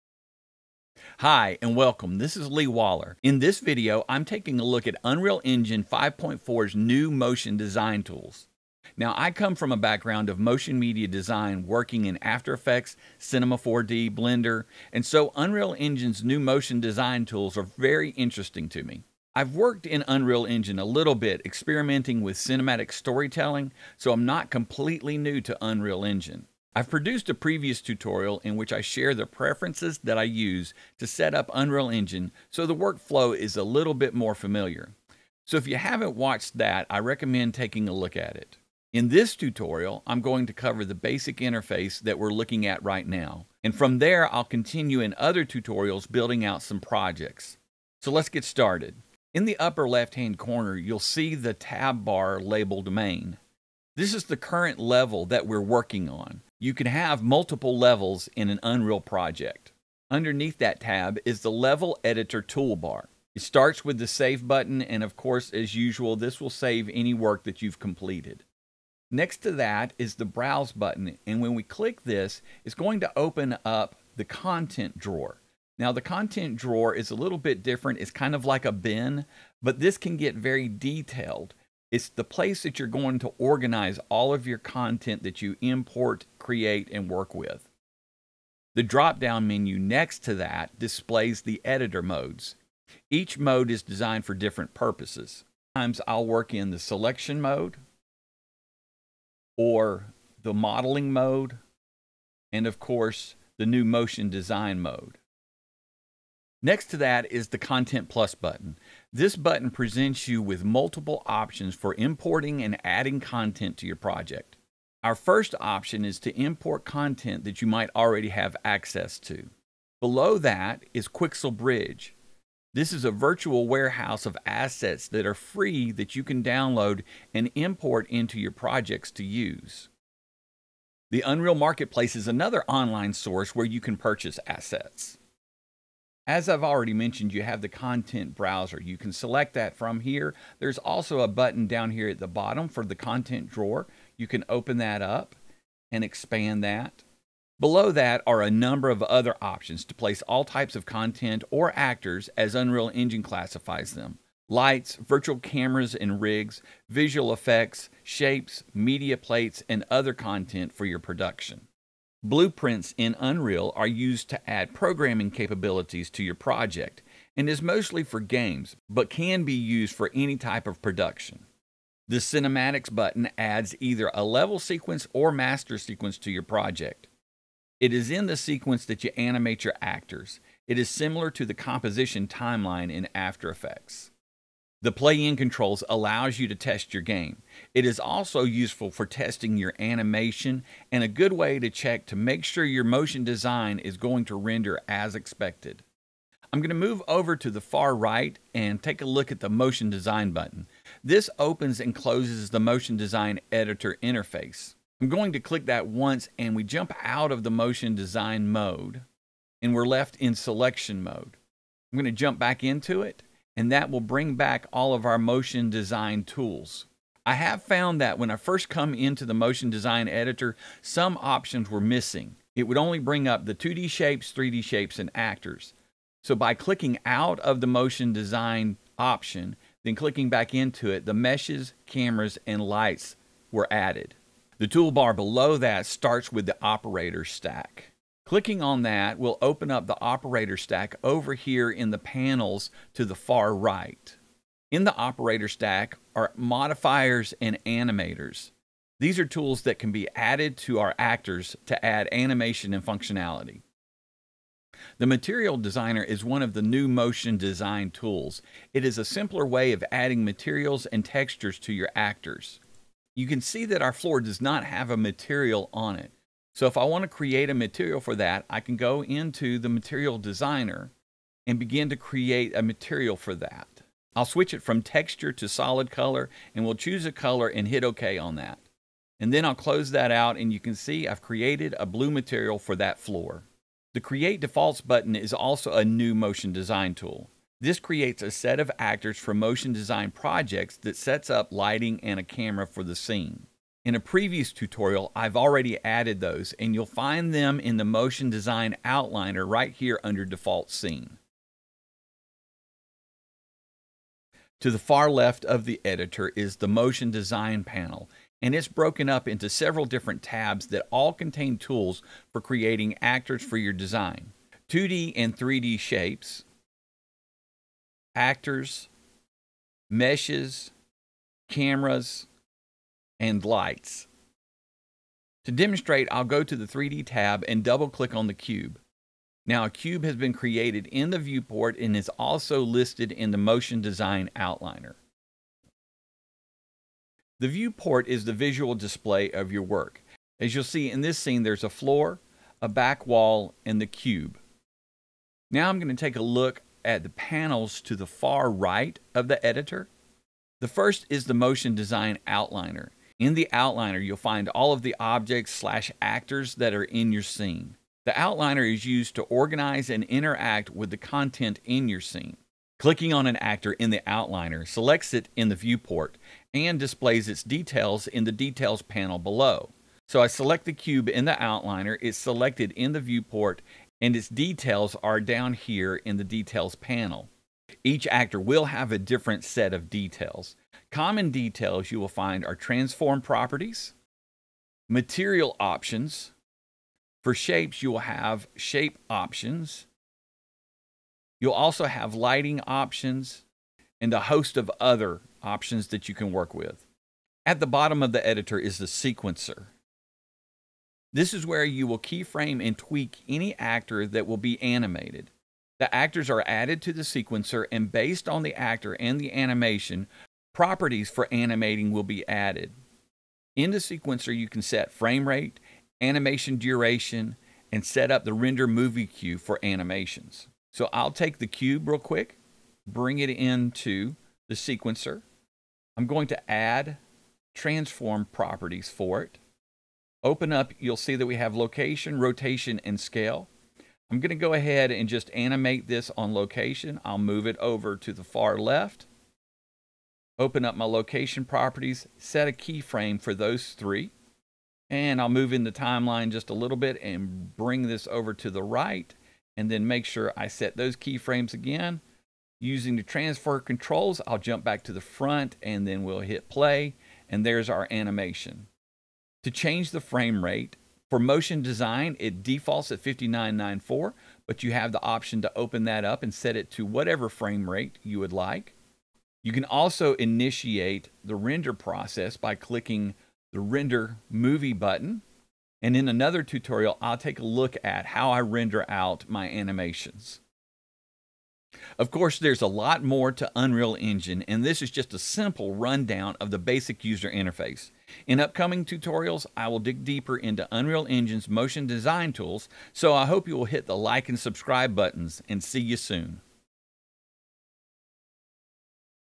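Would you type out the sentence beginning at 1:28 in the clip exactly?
The drop down menu next to that displays the editor modes.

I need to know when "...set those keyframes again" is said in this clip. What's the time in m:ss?
7:30.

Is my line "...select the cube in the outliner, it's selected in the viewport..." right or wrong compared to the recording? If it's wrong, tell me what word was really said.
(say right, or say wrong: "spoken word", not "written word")
right.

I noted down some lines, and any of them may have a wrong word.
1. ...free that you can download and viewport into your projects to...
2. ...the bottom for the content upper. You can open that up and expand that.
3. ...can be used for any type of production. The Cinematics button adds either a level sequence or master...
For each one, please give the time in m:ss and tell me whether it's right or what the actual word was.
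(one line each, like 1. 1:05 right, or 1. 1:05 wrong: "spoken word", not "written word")
1. 2:05 wrong: "import", not "viewport"
2. 2:22 wrong: "drawer", not "upper"
3. 2:49 right.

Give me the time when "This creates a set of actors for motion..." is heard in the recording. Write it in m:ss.
4:47.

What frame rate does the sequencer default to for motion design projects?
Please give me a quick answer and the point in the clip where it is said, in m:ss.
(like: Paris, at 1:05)
59.94, at 7:43.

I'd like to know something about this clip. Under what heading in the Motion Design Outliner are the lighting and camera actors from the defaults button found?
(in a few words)
Default Scene.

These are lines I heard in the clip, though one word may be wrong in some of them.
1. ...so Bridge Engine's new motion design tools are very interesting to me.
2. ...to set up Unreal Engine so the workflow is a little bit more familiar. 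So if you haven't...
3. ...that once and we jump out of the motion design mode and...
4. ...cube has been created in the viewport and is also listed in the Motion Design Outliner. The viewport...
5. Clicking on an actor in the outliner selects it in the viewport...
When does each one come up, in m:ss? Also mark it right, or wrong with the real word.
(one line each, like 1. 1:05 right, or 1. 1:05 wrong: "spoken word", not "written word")
1. 0:15 wrong: "Unreal", not "Bridge"
2. 0:30 right
3. 3:25 right
4. 5:29 right
5. 6:02 right.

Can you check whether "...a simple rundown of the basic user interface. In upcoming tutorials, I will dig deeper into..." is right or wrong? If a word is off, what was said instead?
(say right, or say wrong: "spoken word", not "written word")
right.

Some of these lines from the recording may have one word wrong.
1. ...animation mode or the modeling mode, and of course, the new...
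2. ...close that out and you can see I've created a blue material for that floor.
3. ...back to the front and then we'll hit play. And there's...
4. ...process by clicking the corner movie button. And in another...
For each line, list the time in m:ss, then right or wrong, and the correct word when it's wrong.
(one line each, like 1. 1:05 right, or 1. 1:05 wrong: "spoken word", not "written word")
1. 1:36 wrong: "selection", not "animation"
2. 4:39 right
3. 7:34 right
4. 7:51 wrong: "render", not "corner".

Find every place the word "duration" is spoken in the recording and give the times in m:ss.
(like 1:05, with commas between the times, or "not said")
6:56.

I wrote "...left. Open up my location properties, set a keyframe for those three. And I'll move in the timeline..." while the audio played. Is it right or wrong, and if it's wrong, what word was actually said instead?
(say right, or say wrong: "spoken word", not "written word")
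right.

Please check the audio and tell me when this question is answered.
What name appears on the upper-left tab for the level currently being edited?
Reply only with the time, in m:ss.
0:52.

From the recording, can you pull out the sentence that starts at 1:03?
It starts with the Save button, and of course, as usual, this will save any work that you've completed.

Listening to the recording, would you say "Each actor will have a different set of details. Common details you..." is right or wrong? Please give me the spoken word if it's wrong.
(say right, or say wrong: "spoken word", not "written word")
right.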